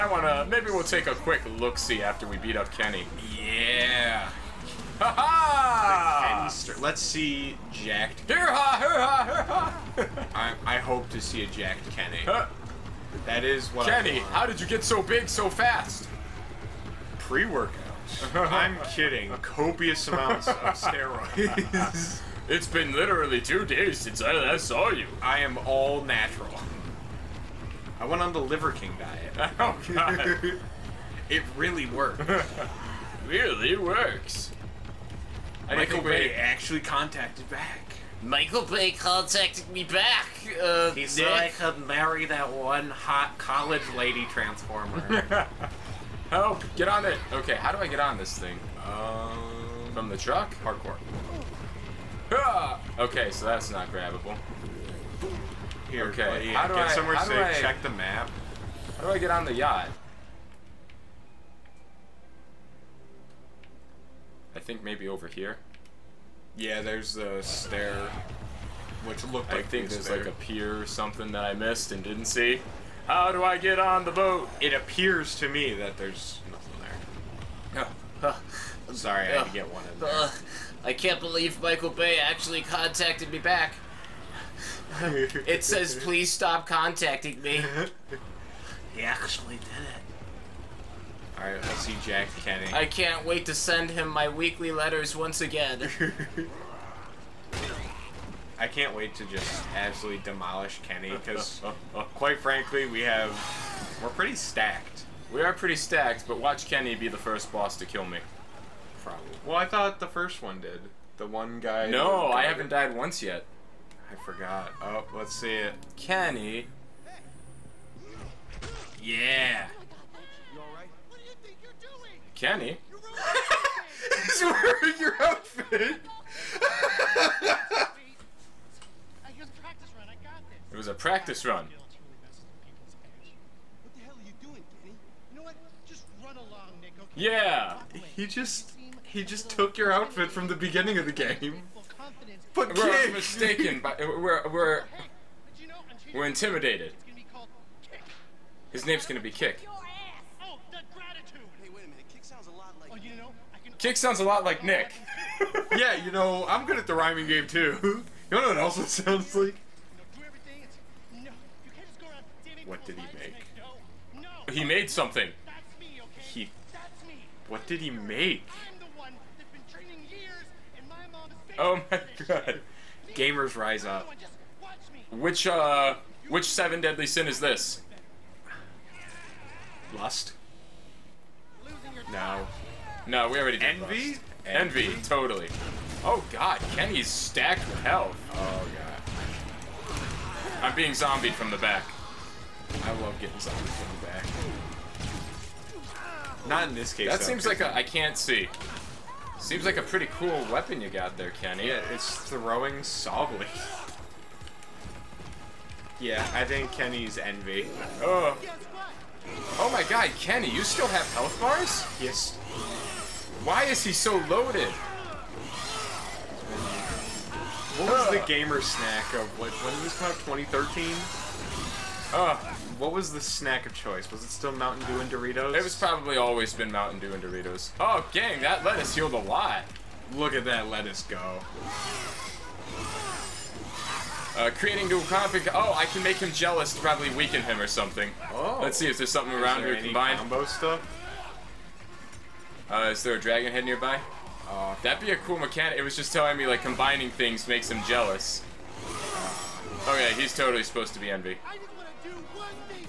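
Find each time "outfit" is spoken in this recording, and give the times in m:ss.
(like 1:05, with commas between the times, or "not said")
2:05, 2:19.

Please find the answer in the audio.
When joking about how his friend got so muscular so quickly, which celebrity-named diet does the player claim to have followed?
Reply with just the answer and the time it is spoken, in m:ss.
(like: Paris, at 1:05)
Liver King diet, at 0:28.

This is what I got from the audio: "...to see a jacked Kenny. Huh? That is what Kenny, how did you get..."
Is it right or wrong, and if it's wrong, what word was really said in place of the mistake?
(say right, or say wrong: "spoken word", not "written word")
right.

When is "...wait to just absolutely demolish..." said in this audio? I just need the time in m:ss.
1:38.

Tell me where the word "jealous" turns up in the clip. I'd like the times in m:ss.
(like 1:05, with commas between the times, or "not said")
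3:56, 4:07.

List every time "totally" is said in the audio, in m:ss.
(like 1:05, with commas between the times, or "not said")
3:05, 4:10.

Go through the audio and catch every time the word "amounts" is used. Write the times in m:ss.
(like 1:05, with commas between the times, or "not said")
0:20.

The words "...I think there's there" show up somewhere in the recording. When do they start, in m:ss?
1:09.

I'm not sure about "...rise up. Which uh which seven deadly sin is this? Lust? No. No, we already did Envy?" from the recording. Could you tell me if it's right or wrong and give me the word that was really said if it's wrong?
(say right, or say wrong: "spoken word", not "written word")
right.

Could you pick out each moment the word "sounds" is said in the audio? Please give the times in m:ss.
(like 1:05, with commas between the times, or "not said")
2:33, 2:38.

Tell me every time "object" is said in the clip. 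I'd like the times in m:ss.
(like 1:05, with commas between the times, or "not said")
not said.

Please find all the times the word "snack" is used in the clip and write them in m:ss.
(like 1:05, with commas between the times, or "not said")
3:38, 3:43.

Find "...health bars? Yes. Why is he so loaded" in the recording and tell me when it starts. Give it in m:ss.
3:31.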